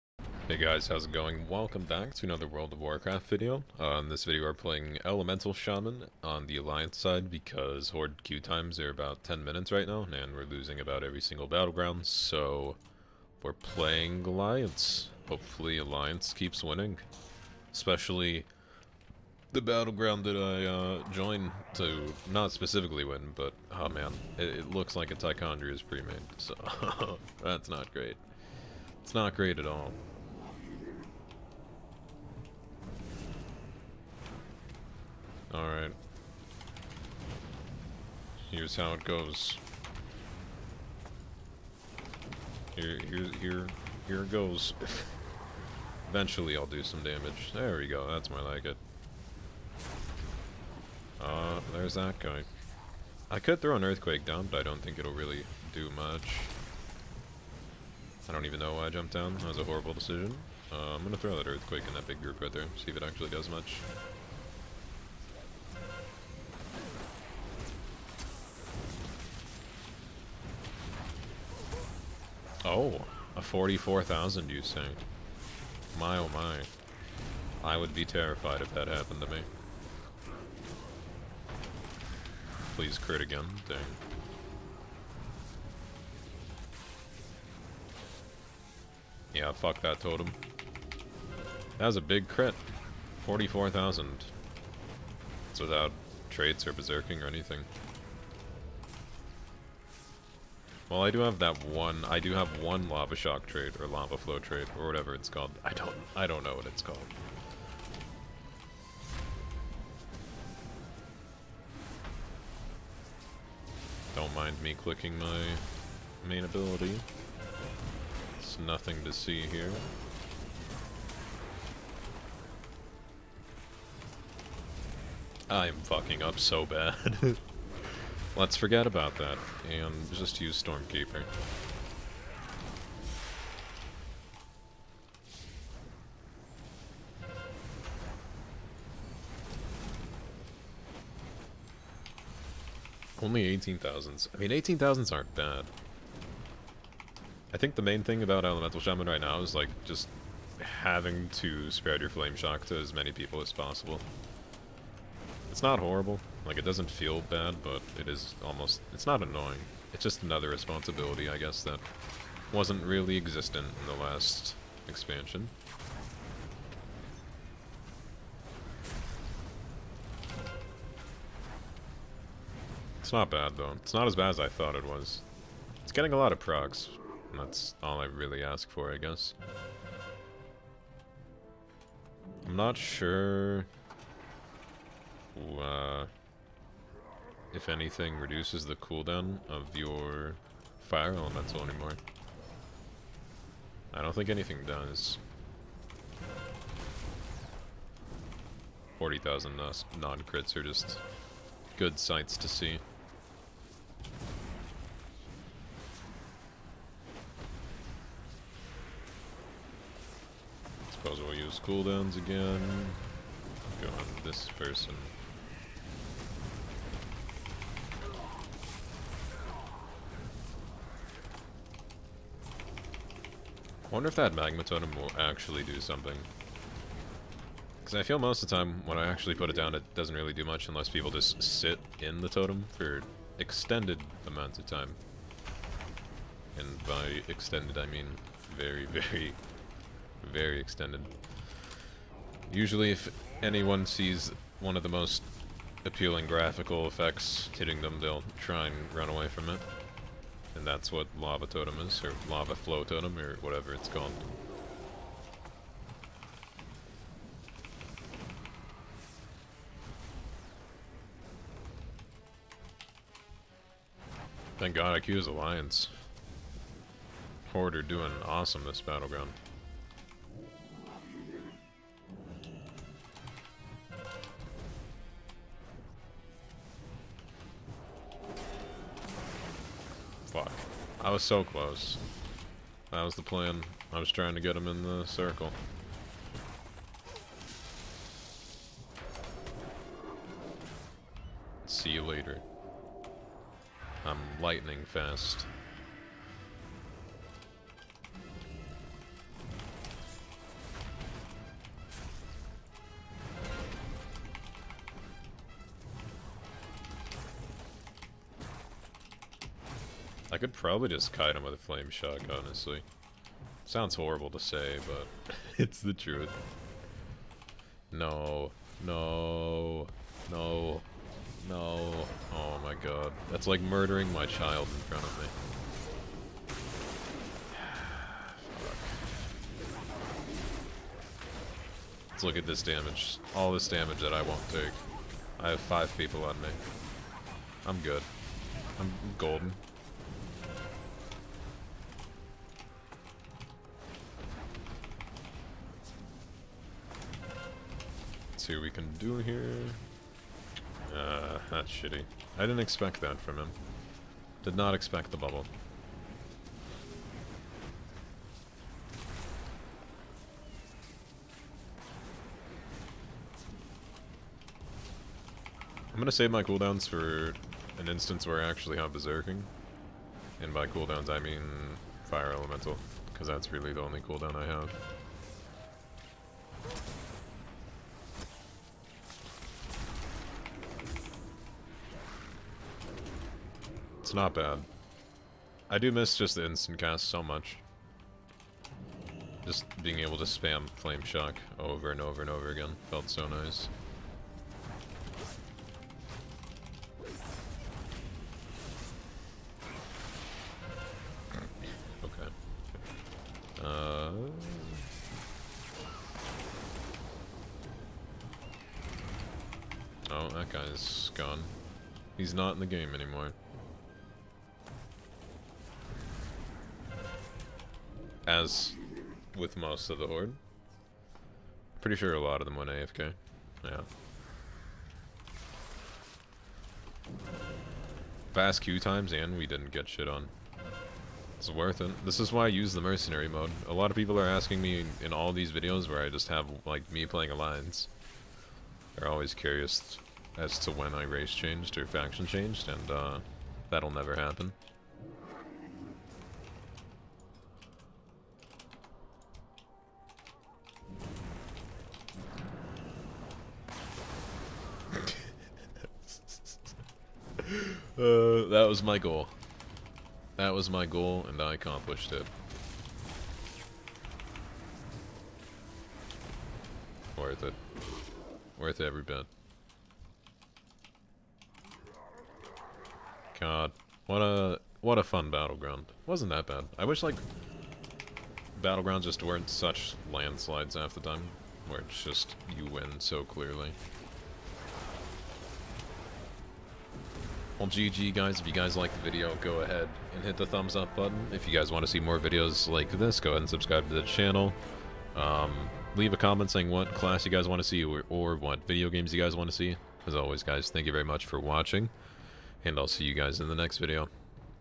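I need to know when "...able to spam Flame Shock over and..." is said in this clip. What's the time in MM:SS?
06:29.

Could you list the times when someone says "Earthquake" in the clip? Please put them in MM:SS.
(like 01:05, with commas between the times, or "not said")
00:53, 01:01.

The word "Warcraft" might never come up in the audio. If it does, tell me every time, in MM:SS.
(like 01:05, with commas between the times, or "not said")
00:02.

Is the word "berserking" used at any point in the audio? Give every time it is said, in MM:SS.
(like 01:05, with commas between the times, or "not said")
01:36, 06:08.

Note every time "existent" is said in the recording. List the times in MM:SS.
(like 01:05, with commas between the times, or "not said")
02:43.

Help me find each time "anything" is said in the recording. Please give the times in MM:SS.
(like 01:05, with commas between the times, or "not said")
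01:37, 03:07, 03:14.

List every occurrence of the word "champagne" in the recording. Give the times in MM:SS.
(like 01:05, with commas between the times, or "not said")
not said.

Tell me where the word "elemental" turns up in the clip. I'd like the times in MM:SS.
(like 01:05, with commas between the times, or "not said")
00:05, 02:28, 03:11, 06:12.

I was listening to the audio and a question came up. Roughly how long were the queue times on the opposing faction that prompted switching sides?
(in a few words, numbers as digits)
10 minutes.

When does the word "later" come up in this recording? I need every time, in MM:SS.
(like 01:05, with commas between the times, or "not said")
04:52.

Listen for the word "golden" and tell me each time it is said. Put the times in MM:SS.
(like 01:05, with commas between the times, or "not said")
05:39.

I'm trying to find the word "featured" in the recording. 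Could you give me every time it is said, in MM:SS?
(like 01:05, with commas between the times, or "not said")
not said.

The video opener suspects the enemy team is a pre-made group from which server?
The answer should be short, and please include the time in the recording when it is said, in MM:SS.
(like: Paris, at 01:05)
Tichondrius, at 00:25.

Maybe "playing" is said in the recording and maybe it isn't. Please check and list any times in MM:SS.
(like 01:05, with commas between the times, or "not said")
00:04, 00:13, 07:17.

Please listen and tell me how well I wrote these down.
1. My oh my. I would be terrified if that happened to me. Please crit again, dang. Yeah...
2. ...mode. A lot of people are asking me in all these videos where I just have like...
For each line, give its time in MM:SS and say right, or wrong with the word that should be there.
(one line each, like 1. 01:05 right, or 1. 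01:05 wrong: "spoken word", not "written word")
1. 01:15 right
2. 07:13 right.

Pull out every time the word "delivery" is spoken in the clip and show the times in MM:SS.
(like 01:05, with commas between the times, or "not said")
not said.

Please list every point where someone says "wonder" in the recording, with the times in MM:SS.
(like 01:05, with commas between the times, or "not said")
03:43.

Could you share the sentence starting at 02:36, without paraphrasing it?
Like, it doesn't feel bad, but it is almost...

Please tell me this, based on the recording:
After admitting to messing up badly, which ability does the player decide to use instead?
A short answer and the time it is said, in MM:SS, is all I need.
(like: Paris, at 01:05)
Stormkeeper, at 02:10.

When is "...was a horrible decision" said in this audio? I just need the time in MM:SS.
00:59.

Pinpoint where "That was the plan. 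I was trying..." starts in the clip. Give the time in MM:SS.
04:42.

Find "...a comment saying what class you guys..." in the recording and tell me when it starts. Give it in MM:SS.
08:16.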